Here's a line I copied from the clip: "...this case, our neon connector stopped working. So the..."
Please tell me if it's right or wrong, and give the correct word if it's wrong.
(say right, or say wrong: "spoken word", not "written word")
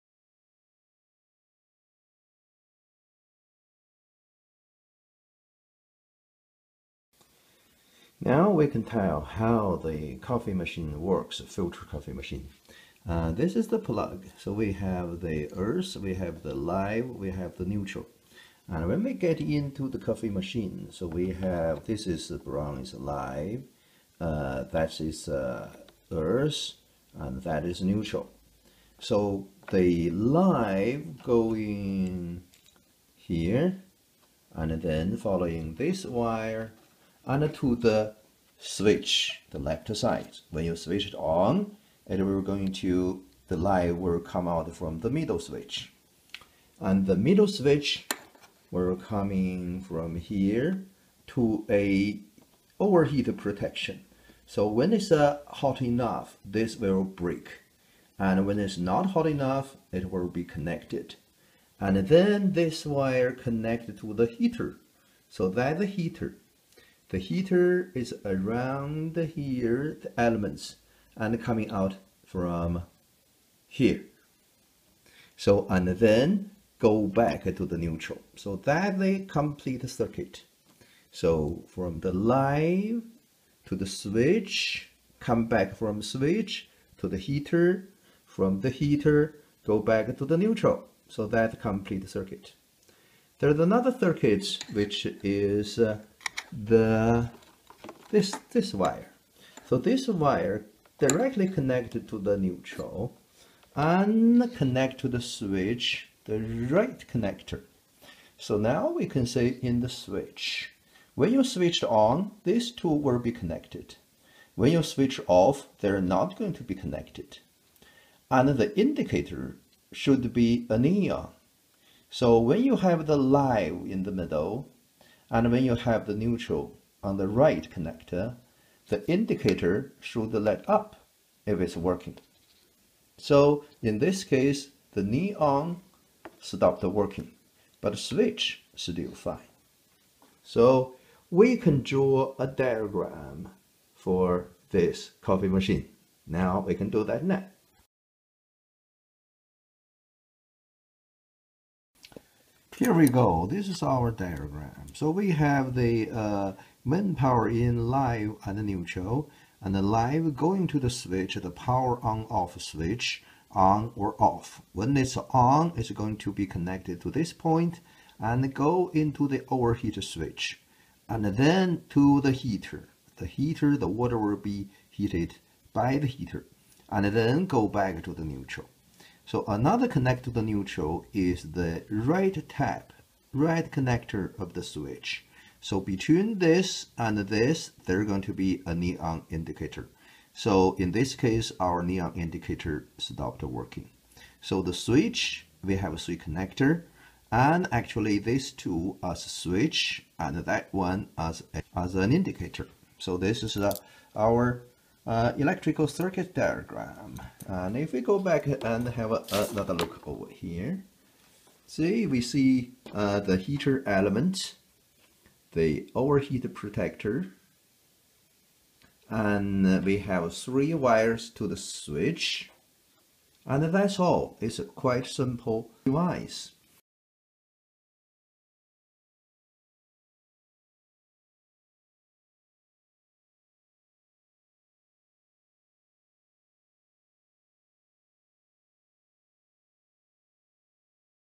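wrong: "indicator", not "connector".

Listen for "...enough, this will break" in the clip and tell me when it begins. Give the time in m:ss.
0:55.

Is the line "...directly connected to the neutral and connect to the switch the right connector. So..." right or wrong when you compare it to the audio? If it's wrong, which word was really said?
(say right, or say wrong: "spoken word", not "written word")
right.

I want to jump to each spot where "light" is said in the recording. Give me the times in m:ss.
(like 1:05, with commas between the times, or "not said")
0:43, 2:10.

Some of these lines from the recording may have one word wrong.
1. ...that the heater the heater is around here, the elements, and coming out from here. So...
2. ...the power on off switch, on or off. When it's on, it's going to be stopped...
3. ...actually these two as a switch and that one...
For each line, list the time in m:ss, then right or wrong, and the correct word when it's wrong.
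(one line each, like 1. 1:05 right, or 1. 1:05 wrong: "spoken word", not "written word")
1. 1:05 right
2. 2:41 wrong: "connected", not "stopped"
3. 3:17 right.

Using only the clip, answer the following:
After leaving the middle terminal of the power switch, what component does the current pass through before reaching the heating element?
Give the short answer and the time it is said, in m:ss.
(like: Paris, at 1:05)
Overheat protection, at 0:52.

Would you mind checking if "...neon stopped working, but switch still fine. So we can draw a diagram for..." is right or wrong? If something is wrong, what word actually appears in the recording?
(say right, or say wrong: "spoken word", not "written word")
right.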